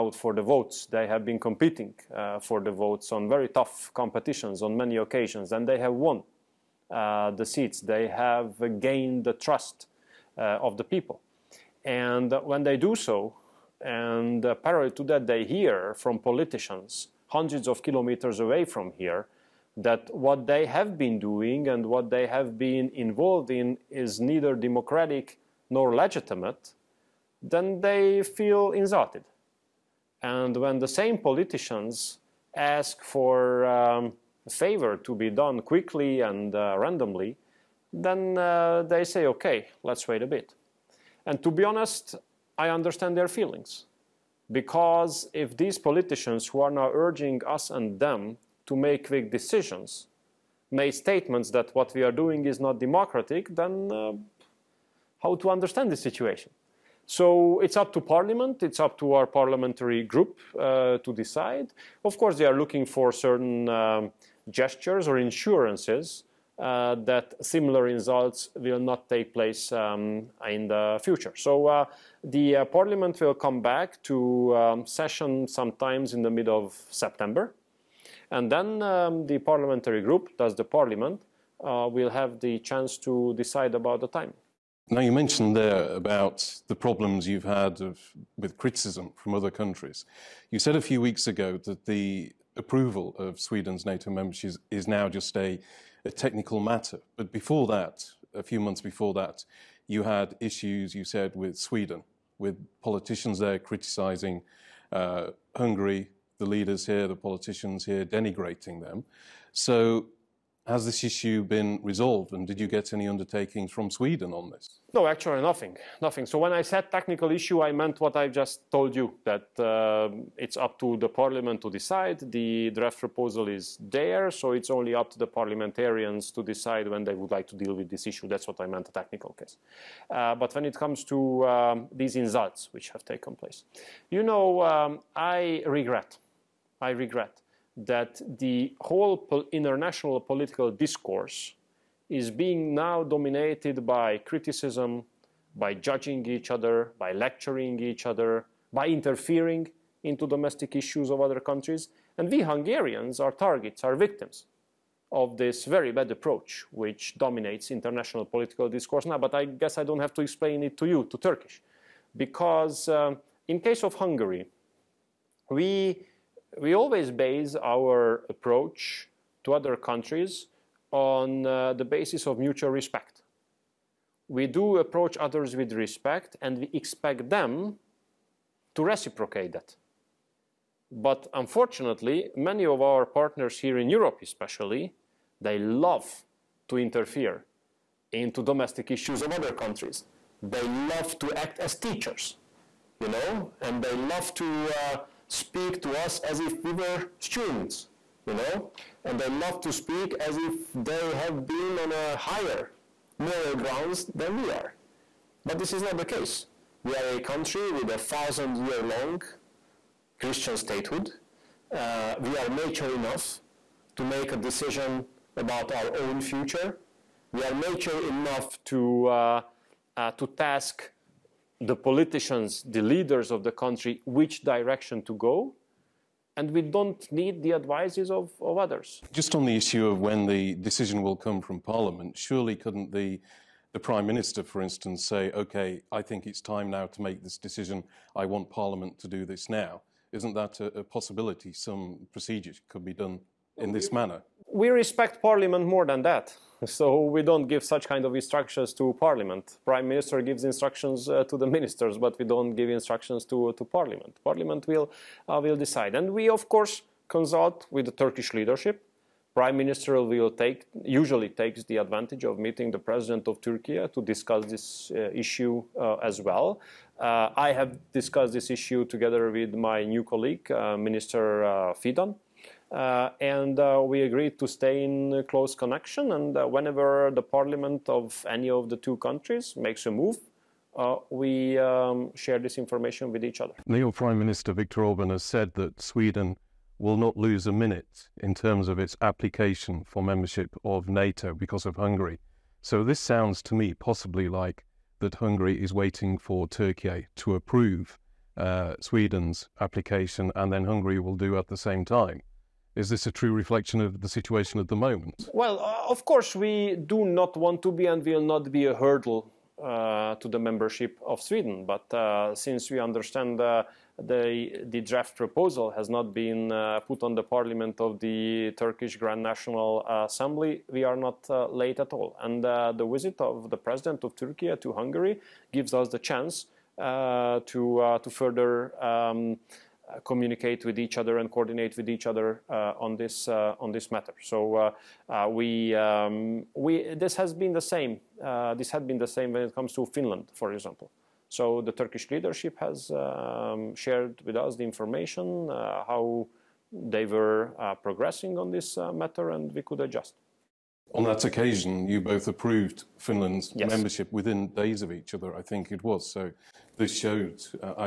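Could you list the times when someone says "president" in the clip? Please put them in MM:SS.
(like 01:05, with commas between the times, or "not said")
04:22, 05:23.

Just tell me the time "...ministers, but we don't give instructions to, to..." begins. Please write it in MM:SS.
04:11.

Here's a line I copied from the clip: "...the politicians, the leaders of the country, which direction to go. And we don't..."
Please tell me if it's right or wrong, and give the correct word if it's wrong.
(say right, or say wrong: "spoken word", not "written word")
right.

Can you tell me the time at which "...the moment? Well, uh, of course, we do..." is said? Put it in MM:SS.
05:04.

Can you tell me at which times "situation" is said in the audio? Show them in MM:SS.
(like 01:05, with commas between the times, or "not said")
00:55, 05:04.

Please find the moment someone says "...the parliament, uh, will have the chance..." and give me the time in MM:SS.
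01:20.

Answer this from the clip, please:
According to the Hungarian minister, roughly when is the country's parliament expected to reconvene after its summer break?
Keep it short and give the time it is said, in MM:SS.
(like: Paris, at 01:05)
Middle of September, at 01:16.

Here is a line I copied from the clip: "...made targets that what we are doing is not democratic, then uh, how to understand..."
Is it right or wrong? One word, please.
wrong.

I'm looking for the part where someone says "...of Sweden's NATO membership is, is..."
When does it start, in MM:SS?
01:33.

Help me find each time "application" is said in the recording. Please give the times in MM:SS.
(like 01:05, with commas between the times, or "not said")
04:49, 04:59.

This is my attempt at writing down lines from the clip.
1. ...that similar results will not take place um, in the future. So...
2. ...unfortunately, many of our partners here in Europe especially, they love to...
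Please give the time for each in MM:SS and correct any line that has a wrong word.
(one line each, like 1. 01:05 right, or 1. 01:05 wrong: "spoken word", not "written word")
1. 01:07 right
2. 03:01 right.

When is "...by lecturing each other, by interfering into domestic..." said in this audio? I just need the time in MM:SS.
02:26.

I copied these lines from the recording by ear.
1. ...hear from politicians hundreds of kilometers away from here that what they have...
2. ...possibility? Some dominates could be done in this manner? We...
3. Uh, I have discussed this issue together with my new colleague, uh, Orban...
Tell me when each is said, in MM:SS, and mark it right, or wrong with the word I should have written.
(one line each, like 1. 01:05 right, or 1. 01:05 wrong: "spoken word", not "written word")
1. 00:15 right
2. 04:00 wrong: "procedures", not "dominates"
3. 04:26 wrong: "Minister", not "Orban".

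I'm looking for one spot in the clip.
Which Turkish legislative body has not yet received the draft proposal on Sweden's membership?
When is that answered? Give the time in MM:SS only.
05:18.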